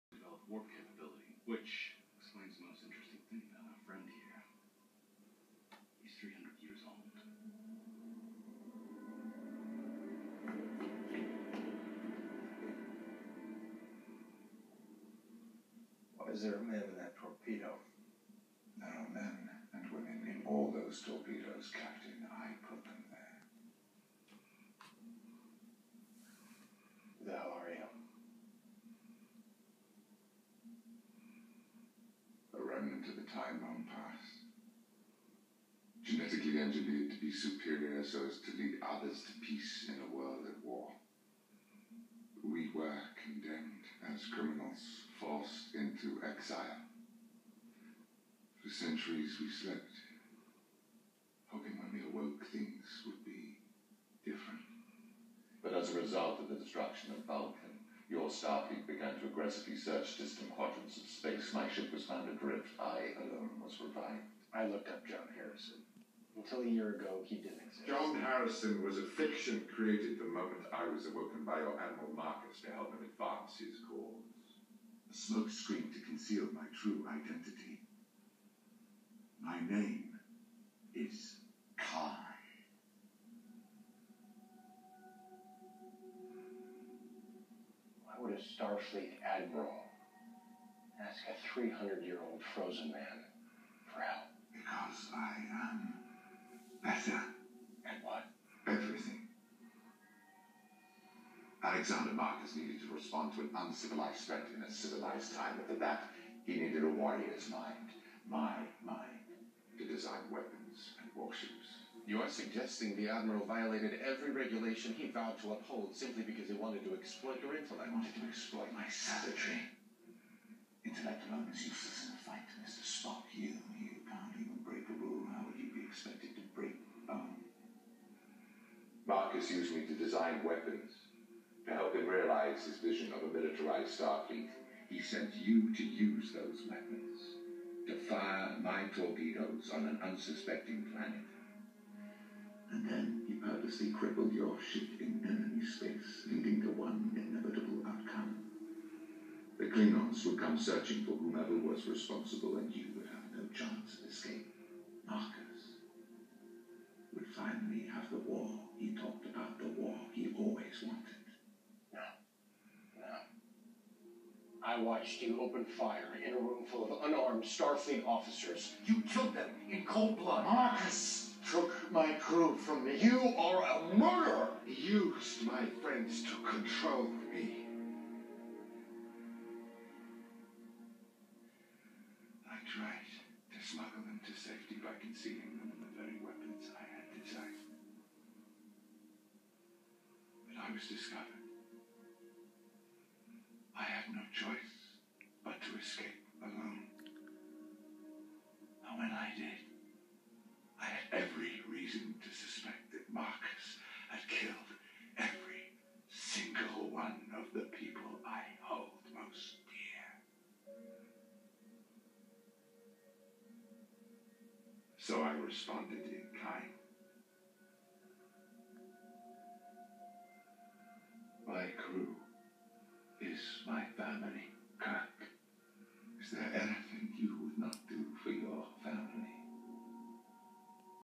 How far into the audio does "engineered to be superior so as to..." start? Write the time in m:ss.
0:36.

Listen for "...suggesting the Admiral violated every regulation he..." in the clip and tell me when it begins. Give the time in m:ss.
1:52.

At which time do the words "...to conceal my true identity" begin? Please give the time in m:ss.
1:15.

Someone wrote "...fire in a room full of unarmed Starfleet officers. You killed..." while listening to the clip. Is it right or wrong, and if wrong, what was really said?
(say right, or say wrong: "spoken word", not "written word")
right.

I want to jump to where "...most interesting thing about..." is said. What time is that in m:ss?
0:02.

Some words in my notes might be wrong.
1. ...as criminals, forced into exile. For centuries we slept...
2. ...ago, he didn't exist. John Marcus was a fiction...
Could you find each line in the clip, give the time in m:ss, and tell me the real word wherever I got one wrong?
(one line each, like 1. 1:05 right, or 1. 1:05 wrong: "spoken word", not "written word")
1. 0:44 right
2. 1:06 wrong: "Harrison", not "Marcus".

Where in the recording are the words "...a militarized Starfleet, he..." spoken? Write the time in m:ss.
2:13.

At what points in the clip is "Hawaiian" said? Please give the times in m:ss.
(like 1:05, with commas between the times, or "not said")
not said.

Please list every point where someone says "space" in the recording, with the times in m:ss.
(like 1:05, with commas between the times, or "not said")
1:01, 2:25.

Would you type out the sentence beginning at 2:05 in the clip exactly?
How would you be expected to break a bone?